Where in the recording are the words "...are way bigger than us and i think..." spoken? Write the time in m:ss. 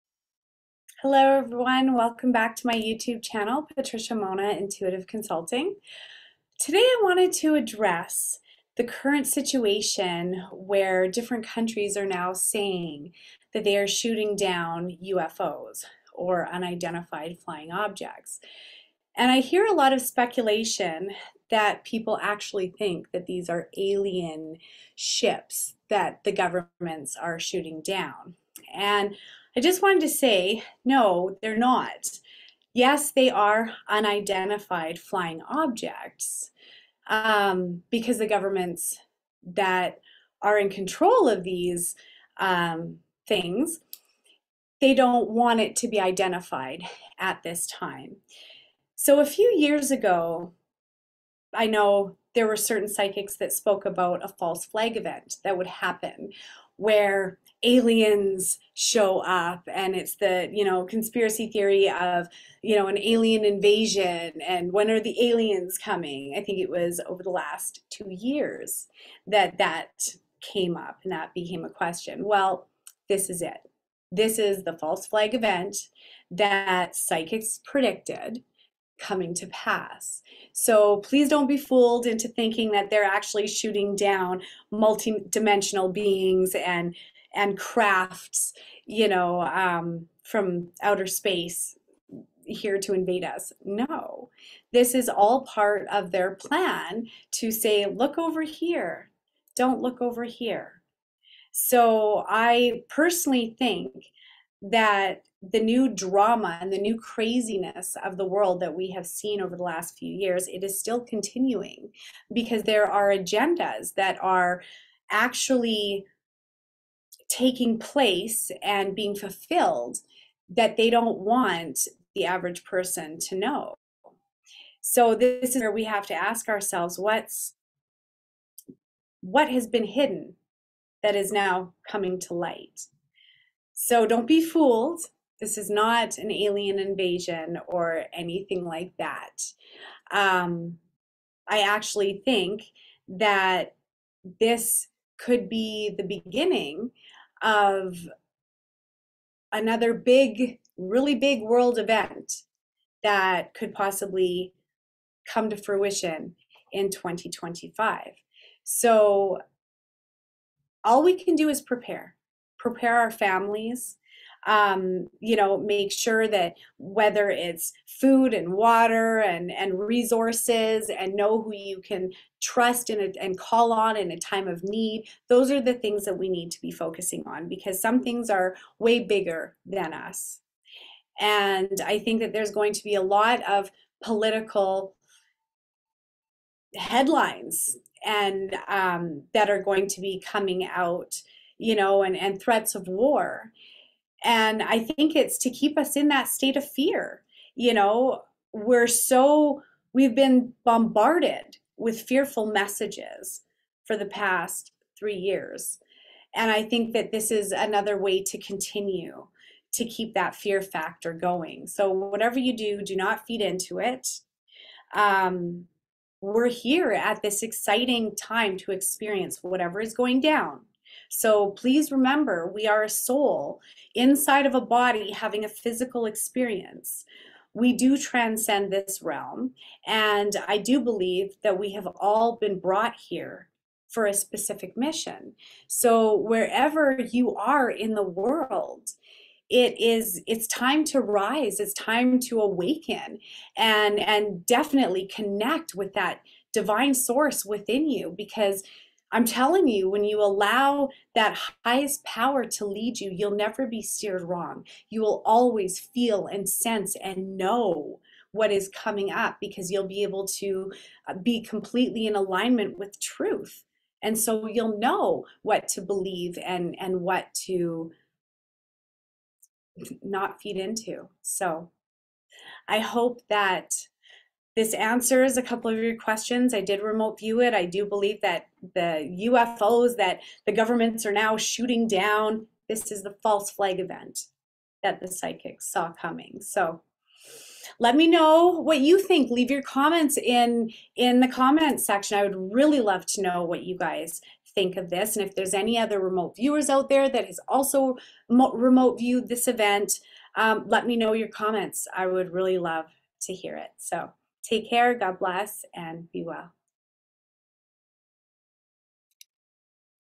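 2:58.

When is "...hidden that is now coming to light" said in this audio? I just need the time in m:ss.
2:09.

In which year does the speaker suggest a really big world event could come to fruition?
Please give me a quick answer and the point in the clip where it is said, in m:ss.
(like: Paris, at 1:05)
2025, at 2:36.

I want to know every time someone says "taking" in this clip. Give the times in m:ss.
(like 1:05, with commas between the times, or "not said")
1:57.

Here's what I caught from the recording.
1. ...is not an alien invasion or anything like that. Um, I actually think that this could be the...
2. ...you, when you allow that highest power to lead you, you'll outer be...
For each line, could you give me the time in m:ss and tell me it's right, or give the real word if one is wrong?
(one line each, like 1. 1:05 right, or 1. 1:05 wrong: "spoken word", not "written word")
1. 2:15 right
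2. 4:09 wrong: "never", not "outer".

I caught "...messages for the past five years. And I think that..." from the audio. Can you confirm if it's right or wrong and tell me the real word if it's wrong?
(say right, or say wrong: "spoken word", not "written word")
wrong: "three", not "five".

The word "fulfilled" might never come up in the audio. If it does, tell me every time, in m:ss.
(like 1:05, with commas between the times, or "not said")
1:59.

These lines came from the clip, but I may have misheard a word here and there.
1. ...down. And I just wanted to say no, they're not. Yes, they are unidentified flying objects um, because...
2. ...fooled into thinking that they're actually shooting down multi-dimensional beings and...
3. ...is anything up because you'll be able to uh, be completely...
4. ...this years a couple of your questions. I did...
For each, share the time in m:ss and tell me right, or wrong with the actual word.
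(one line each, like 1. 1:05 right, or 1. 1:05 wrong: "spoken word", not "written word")
1. 0:27 right
2. 1:21 right
3. 4:18 wrong: "coming", not "anything"
4. 4:34 wrong: "answers", not "years".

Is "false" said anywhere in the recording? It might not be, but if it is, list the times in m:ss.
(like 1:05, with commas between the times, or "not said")
0:54, 1:14, 4:43.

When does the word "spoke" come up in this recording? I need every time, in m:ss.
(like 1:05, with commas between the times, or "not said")
0:53.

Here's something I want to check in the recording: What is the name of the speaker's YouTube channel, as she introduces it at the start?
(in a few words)
Patricia Monna Intuitive Consulting.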